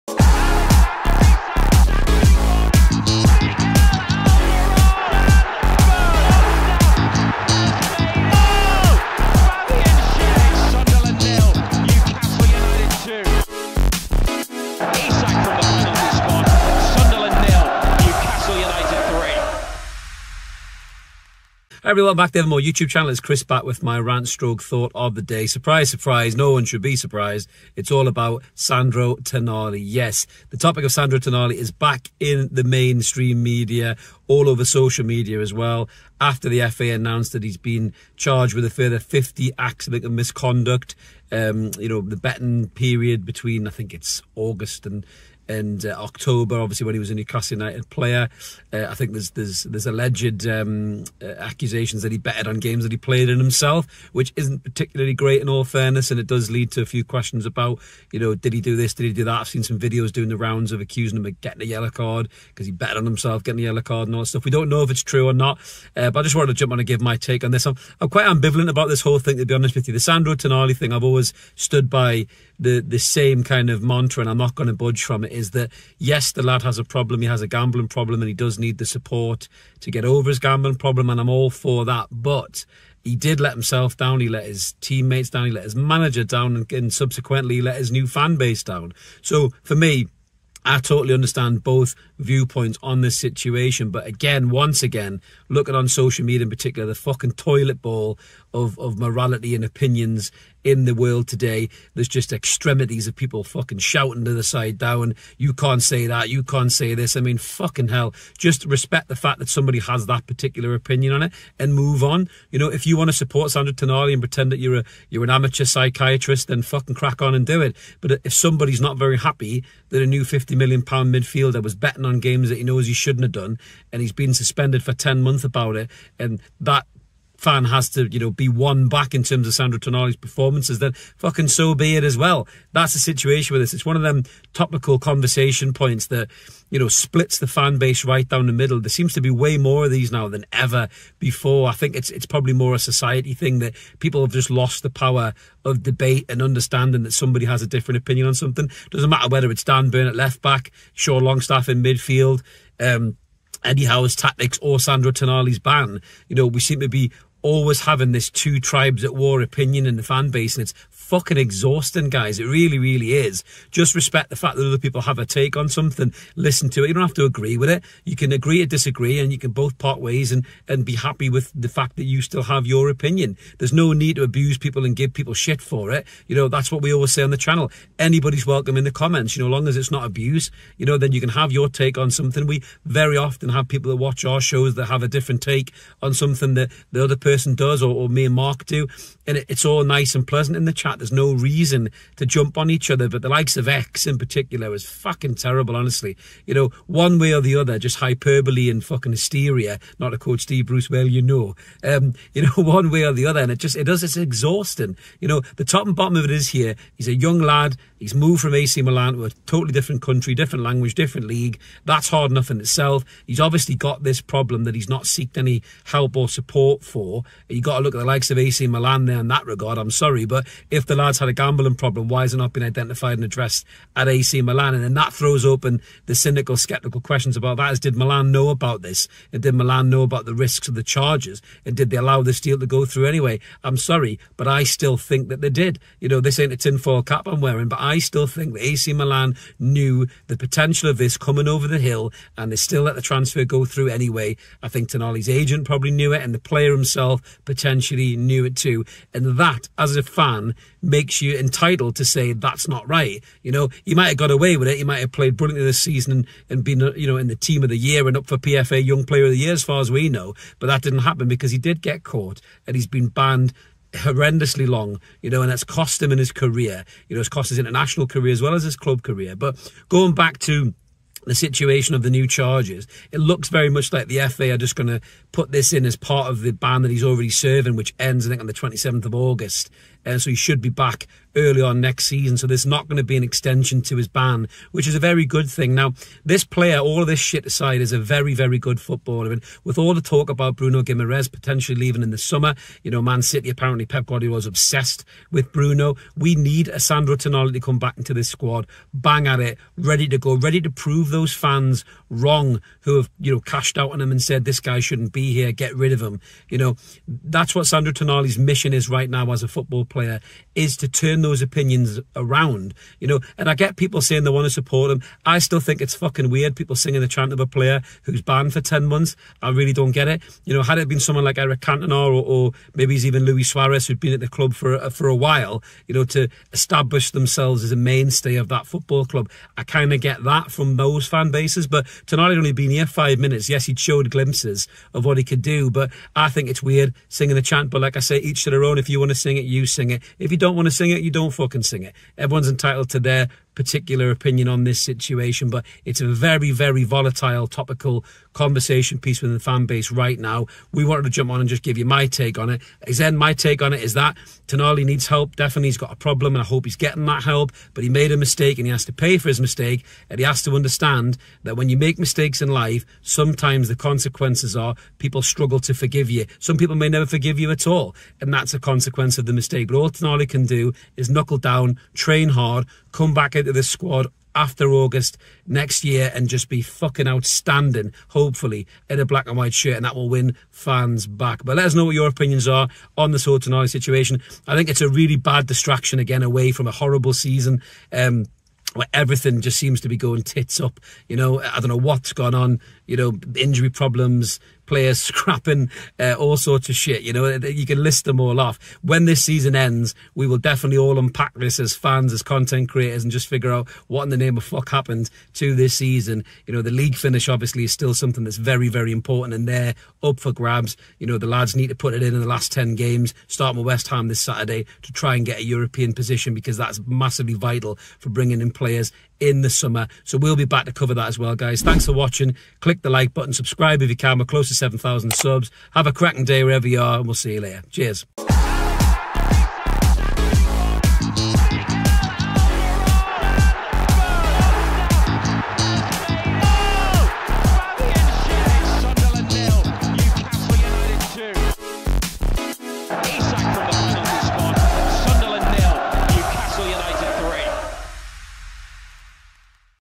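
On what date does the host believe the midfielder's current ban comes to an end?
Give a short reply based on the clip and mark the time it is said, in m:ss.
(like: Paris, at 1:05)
27th of August, at 4:38.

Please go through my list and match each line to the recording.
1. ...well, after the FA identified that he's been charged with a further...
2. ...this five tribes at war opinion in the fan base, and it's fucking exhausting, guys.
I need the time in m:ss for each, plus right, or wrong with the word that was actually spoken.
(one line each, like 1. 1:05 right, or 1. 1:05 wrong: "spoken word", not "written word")
1. 0:35 wrong: "announced", not "identified"
2. 2:38 wrong: "two", not "five".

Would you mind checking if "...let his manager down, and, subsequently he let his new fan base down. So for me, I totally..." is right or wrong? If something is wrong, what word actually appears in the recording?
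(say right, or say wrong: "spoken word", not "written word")
right.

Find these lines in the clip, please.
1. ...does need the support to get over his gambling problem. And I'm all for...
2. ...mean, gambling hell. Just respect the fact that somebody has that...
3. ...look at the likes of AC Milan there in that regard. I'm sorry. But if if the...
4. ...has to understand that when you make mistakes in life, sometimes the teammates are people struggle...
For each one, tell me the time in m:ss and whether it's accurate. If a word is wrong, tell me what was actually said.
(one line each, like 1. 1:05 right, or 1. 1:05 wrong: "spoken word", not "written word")
1. 1:18 right
2. 1:47 wrong: "fucking", not "gambling"
3. 3:37 right
4. 6:00 wrong: "consequences", not "teammates".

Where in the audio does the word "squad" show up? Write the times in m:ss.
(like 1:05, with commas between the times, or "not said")
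4:58, 6:13.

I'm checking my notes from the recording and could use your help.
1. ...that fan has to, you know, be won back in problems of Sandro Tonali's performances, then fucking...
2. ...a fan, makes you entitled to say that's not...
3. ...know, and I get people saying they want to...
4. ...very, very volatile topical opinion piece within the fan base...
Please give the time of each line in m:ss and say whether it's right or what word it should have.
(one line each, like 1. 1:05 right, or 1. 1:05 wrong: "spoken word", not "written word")
1. 2:06 wrong: "terms", not "problems"
2. 4:09 right
3. 5:13 right
4. 5:46 wrong: "conversation", not "opinion".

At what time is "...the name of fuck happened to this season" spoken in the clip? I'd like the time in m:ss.
6:44.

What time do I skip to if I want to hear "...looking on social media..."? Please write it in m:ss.
1:35.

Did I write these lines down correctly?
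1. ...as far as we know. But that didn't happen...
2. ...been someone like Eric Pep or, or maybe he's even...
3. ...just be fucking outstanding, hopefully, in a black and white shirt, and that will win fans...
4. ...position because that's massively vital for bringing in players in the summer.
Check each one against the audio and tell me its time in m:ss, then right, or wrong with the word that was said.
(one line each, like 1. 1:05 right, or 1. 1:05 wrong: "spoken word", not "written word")
1. 4:19 right
2. 5:20 wrong: "Cantona", not "Pep"
3. 6:16 right
4. 6:55 right.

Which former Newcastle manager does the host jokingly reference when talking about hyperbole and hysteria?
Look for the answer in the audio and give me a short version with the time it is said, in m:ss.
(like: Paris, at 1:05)
Steve Bruce, at 3:20.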